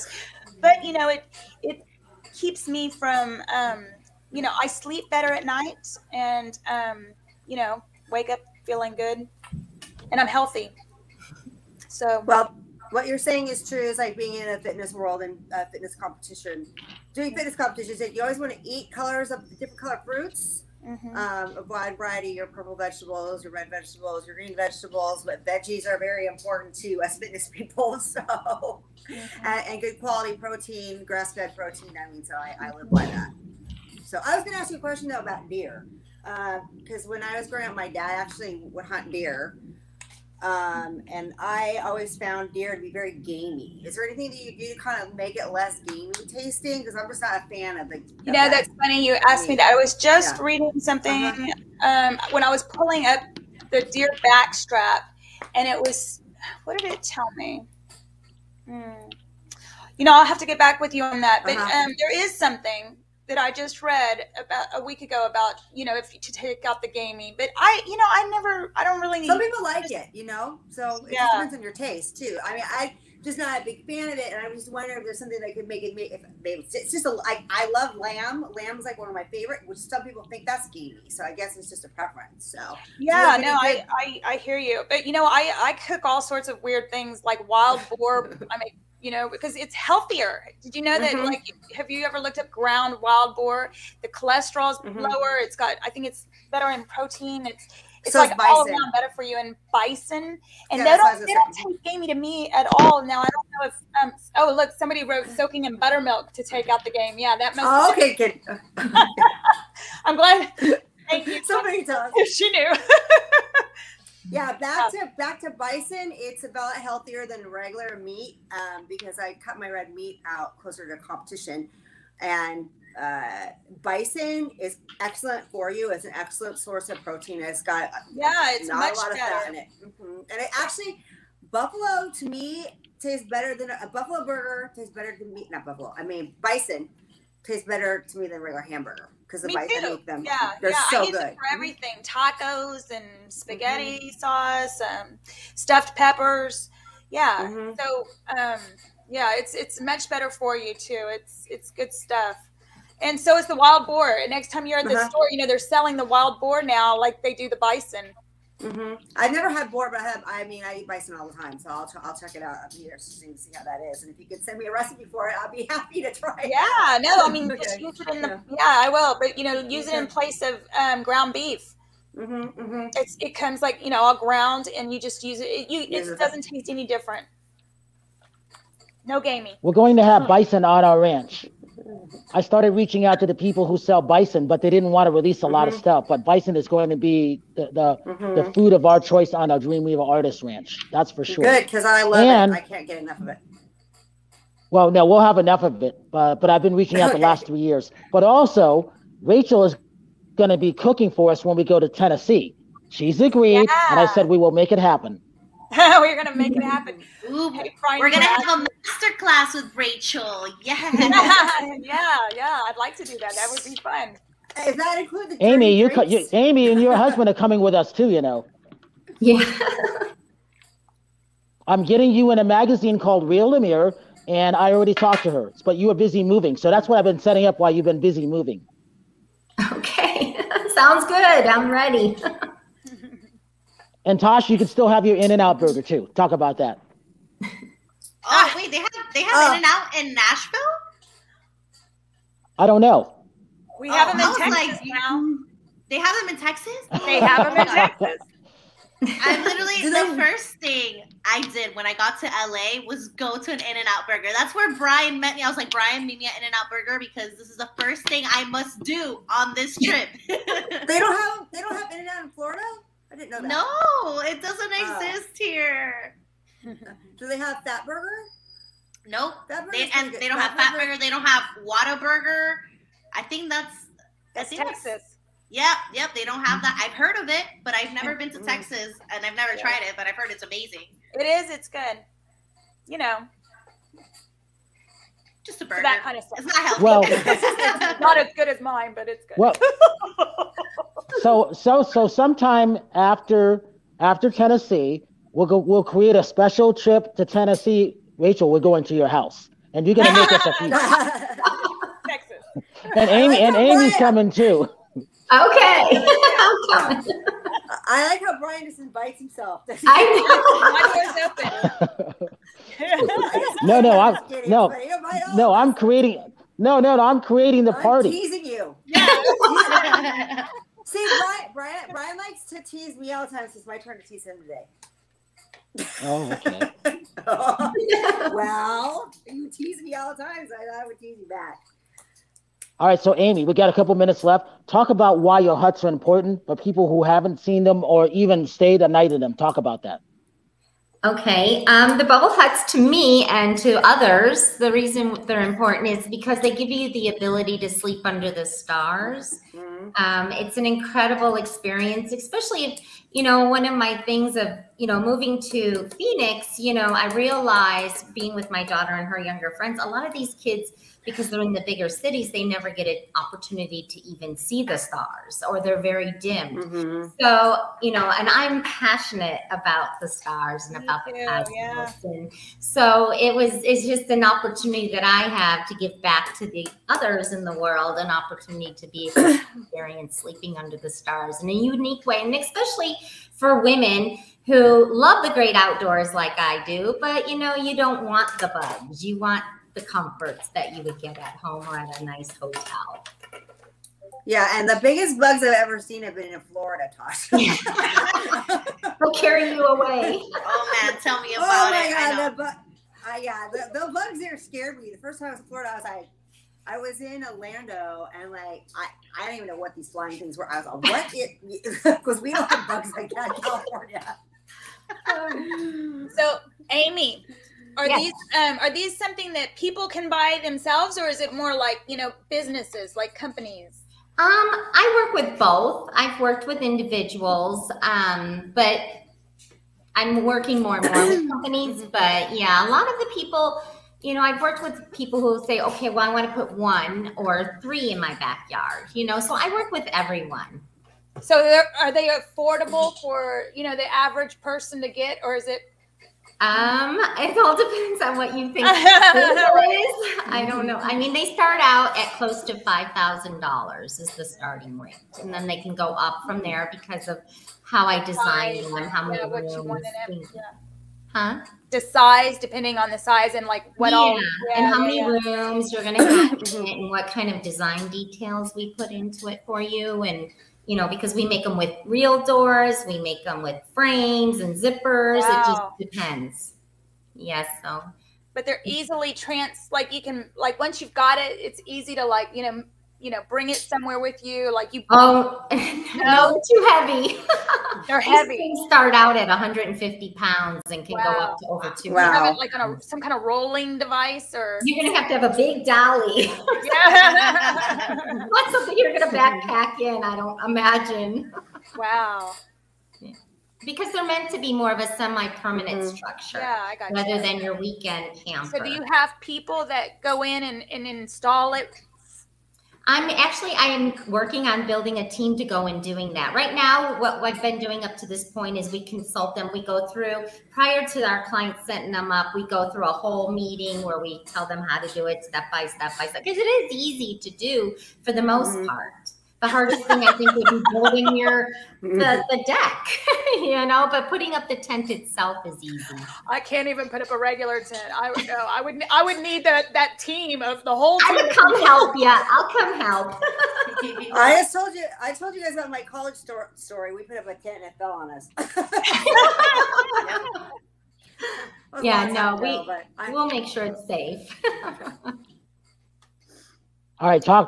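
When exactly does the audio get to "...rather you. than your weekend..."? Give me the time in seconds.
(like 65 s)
506 s.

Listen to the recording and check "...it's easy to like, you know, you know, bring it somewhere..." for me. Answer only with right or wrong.
right.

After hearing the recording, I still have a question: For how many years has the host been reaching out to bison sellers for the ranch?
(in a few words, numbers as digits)
3.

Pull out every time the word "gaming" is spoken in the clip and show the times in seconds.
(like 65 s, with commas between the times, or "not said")
66 s, 179 s.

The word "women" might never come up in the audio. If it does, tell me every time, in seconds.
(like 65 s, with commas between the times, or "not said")
383 s.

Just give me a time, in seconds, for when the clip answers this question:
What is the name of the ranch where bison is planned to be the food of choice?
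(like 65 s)
189 s.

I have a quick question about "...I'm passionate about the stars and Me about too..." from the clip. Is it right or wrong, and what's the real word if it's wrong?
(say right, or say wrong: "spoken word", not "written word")
right.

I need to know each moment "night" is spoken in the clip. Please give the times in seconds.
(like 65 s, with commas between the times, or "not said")
5 s, 338 s.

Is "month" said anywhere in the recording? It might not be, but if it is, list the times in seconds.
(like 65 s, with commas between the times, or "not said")
not said.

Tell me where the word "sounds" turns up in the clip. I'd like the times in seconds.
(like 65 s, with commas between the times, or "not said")
230 s.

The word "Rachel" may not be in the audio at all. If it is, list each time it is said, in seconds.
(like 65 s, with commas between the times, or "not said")
199 s, 209 s, 298 s.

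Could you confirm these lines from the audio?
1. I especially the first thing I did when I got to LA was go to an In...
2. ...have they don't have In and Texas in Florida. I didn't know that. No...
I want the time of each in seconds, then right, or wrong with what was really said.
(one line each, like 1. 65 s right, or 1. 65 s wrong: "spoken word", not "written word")
1. 249 s wrong: "literally", not "especially"
2. 260 s wrong: "Out", not "Texas".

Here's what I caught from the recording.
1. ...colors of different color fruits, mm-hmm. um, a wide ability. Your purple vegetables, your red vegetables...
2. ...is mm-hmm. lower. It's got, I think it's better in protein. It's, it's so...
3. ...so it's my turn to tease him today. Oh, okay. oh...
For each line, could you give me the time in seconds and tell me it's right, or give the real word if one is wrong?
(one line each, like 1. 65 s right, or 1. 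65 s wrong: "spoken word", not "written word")
1. 18 s wrong: "variety", not "ability"
2. 94 s right
3. 323 s right.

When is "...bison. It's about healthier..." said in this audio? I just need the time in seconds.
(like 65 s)
115 s.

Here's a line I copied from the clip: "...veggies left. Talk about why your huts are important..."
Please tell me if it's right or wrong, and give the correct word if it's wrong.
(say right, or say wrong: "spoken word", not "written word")
wrong: "minutes", not "veggies".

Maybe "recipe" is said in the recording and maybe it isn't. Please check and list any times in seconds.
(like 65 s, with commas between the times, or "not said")
164 s.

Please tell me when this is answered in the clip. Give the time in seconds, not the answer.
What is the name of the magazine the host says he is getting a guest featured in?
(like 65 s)
223 s.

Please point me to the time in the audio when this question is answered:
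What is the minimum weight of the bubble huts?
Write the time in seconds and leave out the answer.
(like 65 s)
489 s.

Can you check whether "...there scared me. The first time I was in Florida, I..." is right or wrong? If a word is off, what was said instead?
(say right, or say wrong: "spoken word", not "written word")
right.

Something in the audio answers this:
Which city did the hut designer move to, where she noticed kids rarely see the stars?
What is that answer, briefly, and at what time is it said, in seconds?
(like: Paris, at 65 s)
Phoenix, at 355 s.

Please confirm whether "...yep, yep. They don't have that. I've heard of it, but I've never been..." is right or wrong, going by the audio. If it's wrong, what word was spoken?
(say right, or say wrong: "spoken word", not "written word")
right.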